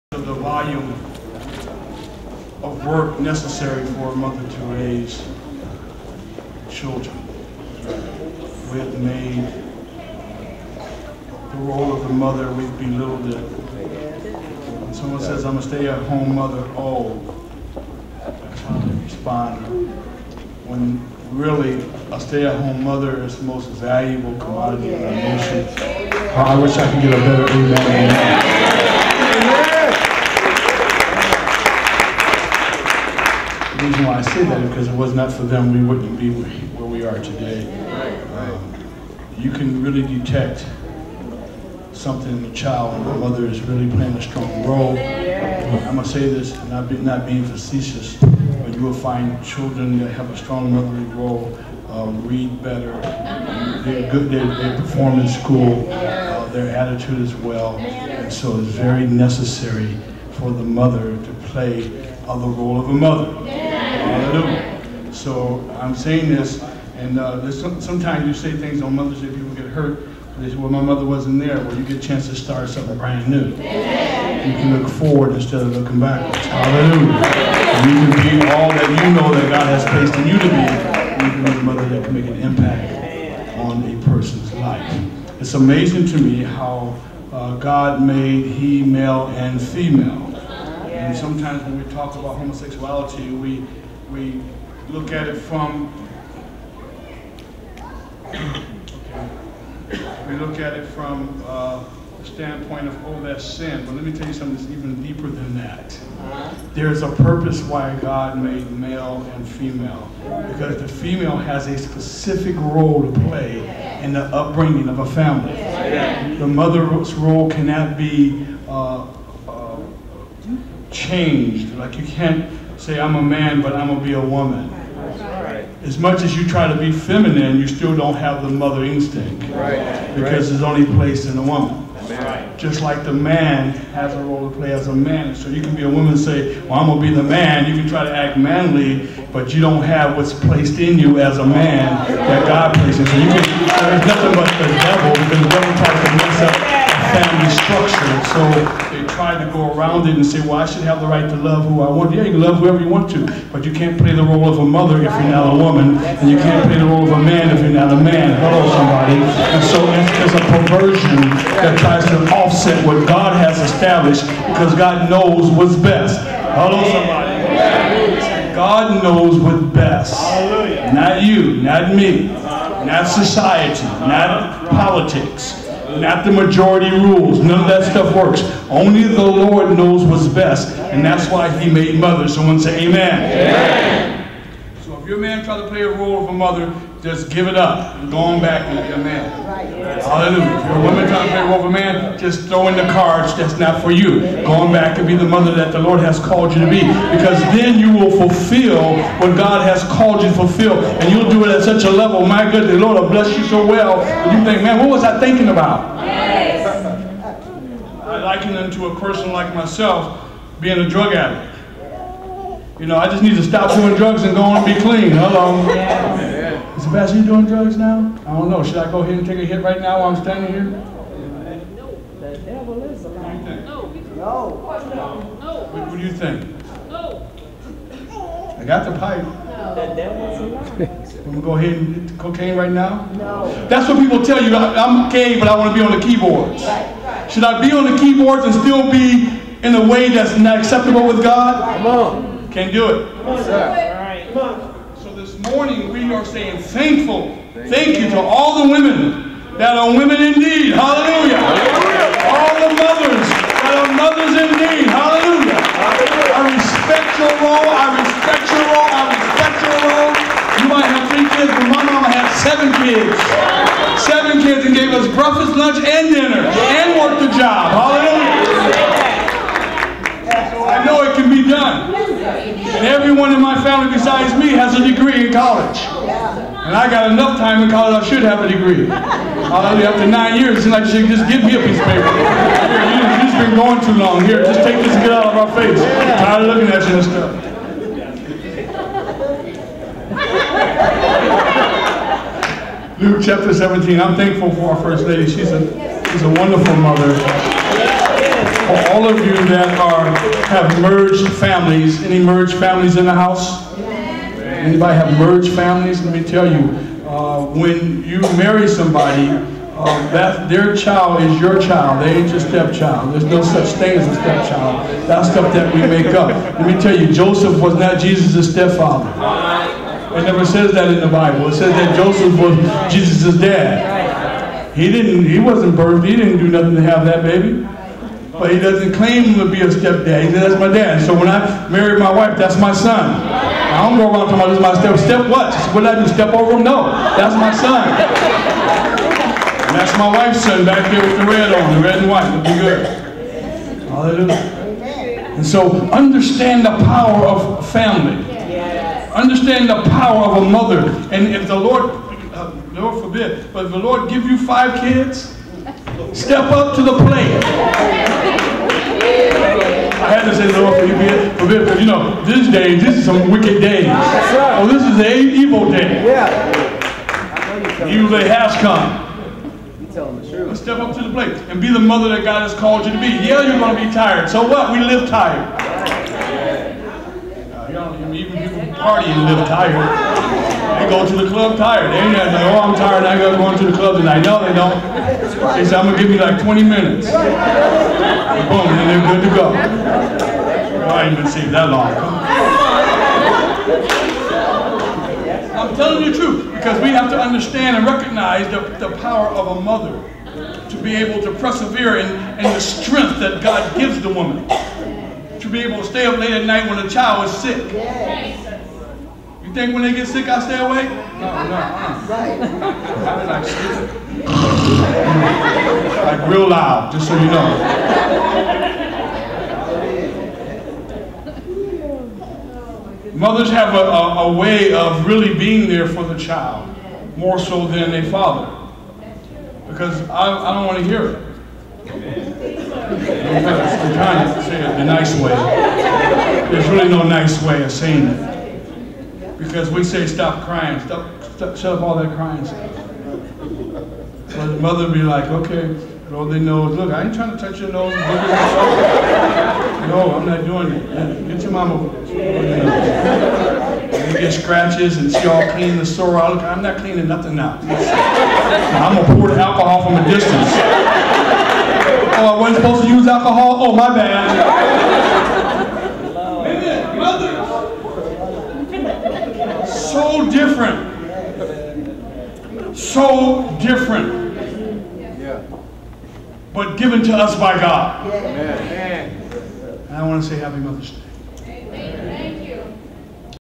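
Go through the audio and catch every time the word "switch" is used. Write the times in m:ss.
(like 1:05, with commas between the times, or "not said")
not said.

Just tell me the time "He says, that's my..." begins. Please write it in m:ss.
5:30.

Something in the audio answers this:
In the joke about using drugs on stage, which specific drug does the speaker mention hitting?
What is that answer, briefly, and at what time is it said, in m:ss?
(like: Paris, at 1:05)
cocaine, at 3:52.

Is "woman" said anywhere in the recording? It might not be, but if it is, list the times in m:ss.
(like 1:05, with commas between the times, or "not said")
2:04, 2:11, 2:15, 2:35, 3:10, 6:44.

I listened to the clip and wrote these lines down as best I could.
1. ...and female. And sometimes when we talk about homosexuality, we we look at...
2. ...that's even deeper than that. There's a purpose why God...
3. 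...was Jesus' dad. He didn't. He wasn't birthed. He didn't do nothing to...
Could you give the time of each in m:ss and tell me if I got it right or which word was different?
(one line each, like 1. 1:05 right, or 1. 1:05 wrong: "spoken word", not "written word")
1. 1:29 right
2. 1:44 right
3. 5:22 right.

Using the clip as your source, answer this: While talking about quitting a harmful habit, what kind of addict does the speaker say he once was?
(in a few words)
drug addict.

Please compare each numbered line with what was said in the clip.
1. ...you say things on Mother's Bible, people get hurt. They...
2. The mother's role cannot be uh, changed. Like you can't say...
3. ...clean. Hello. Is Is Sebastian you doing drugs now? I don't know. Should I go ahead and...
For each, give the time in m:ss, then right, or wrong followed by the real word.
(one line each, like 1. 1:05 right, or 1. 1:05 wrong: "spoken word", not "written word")
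1. 1:08 wrong: "Day", not "Bible"
2. 1:56 right
3. 3:34 right.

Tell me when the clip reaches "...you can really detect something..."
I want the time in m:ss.
0:39.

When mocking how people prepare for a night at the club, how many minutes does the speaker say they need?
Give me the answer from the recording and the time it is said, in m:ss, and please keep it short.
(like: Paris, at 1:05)
20 minutes, at 6:26.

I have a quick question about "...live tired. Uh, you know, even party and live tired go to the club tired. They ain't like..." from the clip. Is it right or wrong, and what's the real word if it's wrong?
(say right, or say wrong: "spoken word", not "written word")
right.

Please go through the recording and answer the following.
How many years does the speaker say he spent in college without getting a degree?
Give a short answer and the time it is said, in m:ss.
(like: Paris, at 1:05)
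9, at 4:40.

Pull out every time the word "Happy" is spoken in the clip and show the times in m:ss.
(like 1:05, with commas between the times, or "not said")
8:00.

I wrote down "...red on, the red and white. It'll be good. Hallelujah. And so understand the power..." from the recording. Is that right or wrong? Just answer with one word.
right.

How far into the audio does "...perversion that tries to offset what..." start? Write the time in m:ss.
2:40.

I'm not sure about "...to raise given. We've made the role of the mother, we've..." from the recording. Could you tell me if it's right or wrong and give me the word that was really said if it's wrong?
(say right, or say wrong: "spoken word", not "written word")
wrong: "children", not "given".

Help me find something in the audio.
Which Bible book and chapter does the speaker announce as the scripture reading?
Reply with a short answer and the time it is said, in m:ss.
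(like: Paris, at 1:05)
Luke 17, at 4:53.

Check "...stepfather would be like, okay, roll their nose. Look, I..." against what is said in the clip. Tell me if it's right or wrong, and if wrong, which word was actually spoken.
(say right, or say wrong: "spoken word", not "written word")
wrong: "mother", not "stepfather".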